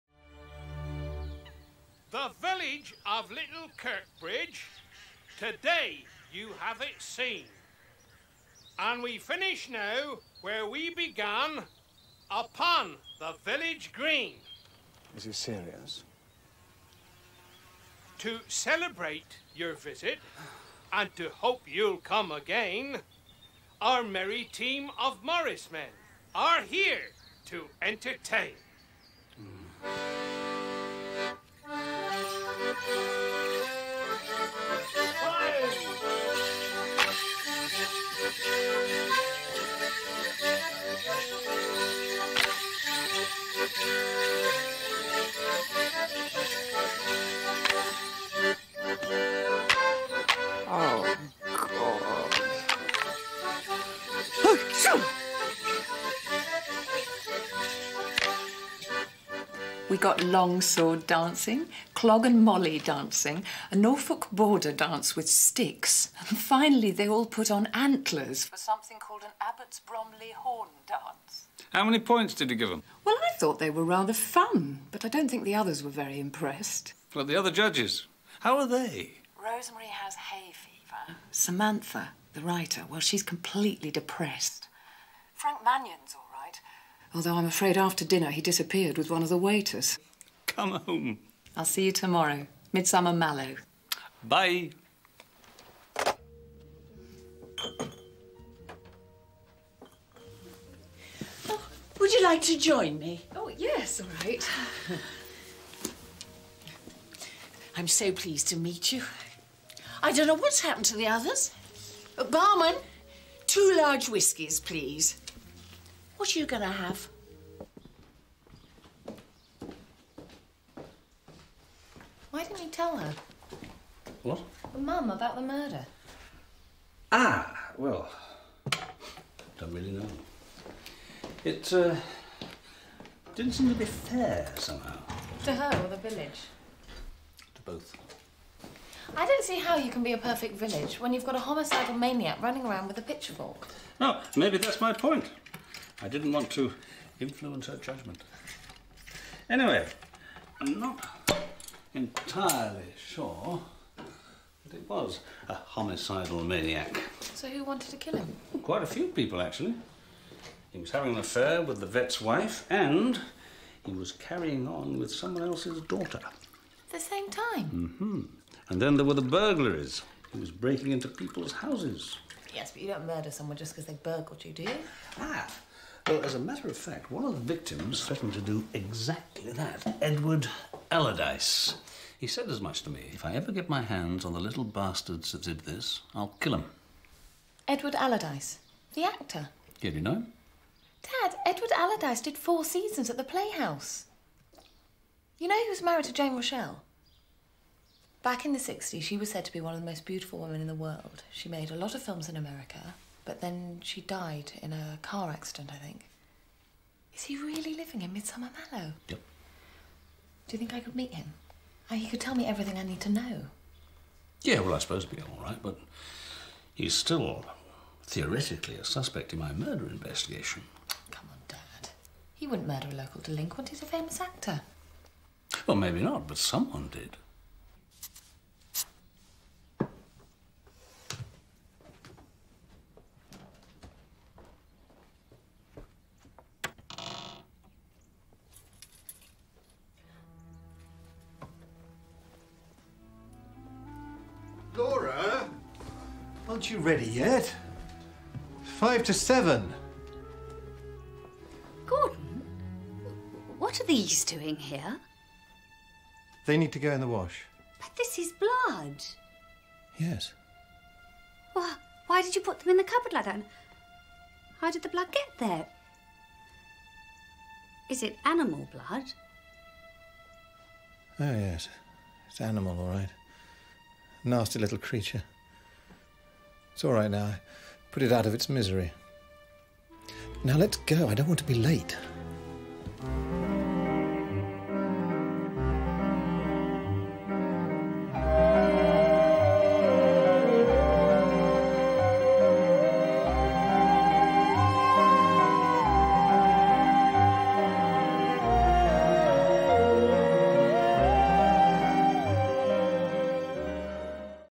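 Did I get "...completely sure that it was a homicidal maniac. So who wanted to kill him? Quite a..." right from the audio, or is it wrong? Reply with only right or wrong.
wrong.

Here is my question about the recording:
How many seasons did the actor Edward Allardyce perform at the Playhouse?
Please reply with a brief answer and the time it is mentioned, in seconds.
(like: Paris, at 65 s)
4, at 192 s.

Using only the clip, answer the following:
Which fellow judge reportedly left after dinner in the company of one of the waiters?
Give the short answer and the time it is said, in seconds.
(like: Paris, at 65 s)
Frank Mannion, at 85 s.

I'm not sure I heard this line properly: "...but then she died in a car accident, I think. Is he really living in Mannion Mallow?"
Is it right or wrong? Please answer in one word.
wrong.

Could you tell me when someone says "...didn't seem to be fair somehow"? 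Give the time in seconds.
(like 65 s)
133 s.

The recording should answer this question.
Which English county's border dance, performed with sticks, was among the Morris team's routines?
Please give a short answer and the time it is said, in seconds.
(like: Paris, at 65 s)
Norfolk, at 63 s.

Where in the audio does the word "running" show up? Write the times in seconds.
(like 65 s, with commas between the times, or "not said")
142 s.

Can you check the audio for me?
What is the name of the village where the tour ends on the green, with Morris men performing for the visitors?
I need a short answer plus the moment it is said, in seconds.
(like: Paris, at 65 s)
Little Kirkbridge, at 3 s.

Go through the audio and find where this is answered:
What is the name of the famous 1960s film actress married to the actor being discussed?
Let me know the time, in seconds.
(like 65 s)
196 s.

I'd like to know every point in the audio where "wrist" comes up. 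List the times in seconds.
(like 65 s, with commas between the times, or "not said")
not said.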